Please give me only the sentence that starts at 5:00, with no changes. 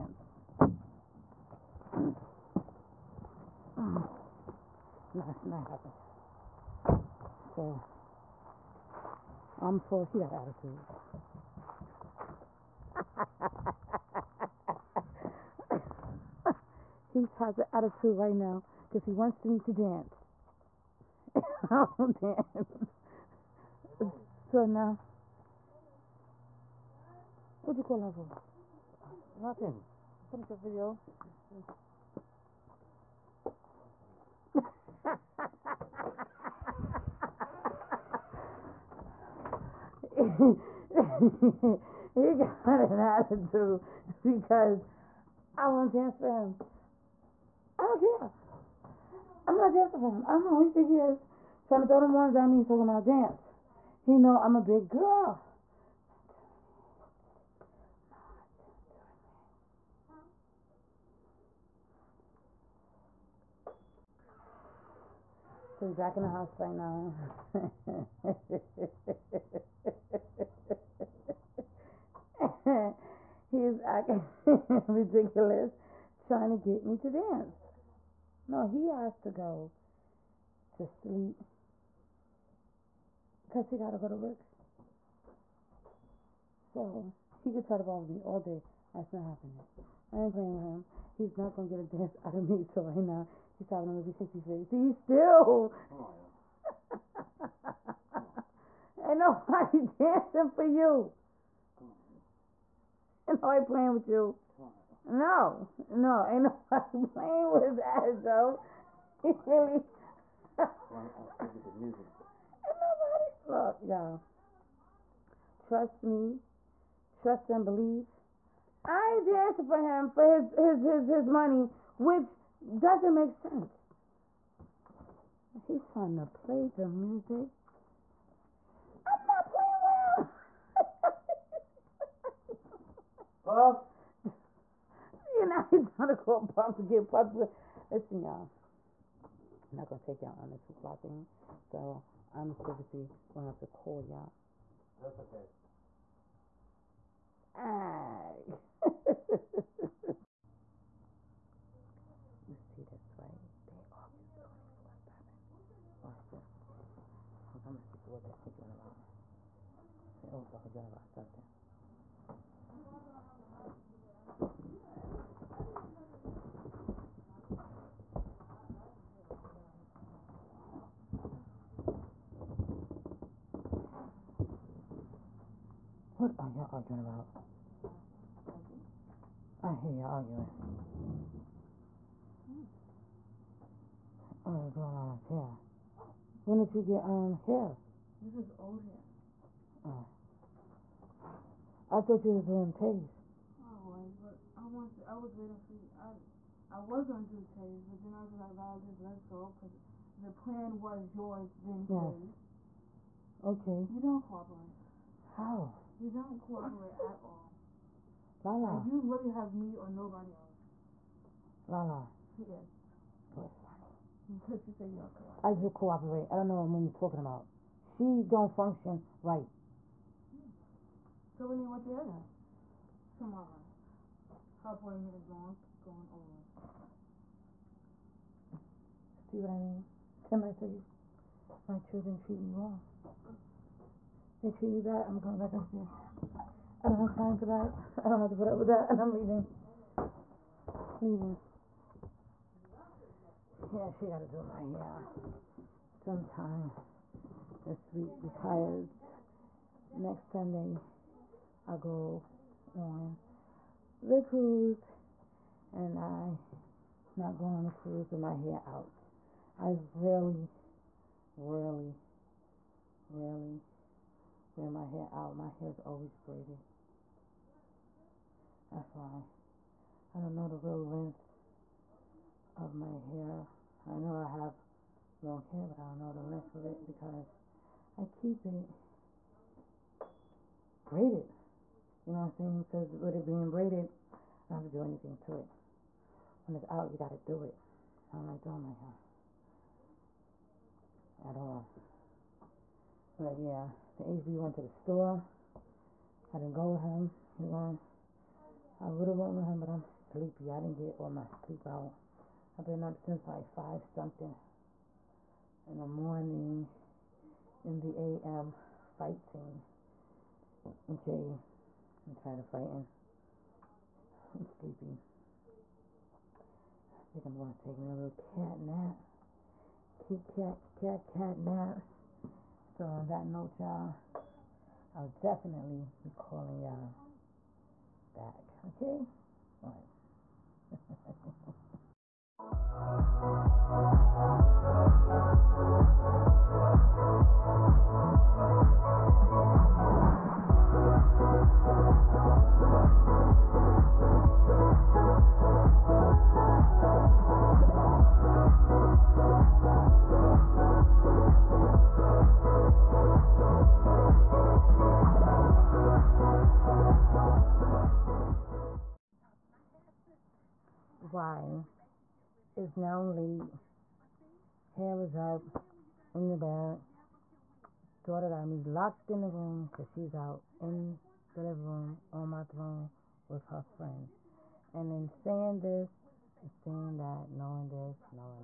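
I didn't get all my sleep out.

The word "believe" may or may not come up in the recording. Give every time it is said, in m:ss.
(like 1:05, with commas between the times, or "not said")
1:57.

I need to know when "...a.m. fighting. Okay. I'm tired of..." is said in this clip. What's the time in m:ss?
5:07.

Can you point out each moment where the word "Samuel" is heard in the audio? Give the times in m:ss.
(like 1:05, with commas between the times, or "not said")
not said.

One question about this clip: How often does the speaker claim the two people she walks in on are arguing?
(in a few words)
24-7.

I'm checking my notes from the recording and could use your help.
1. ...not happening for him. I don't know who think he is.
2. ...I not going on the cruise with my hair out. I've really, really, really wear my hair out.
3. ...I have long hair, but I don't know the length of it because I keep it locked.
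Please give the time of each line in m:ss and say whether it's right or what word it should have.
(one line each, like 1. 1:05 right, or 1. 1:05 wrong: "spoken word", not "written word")
1. 0:49 wrong: "dancing", not "happening"
2. 4:15 right
3. 4:34 wrong: "braided", not "locked".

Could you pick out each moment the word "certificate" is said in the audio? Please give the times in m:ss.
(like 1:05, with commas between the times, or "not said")
not said.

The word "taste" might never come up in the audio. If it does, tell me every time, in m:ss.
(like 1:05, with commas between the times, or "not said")
3:12, 3:17.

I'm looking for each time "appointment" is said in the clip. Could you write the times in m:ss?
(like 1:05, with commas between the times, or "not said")
3:44.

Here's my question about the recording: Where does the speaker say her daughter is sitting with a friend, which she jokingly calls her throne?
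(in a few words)
living room.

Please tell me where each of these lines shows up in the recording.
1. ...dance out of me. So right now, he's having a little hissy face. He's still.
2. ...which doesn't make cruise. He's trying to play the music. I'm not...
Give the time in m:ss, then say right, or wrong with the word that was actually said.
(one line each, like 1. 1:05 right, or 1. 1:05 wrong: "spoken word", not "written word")
1. 1:31 right
2. 2:01 wrong: "sense", not "cruise".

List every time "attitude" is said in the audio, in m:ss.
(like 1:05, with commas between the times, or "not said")
0:10, 0:17, 0:42.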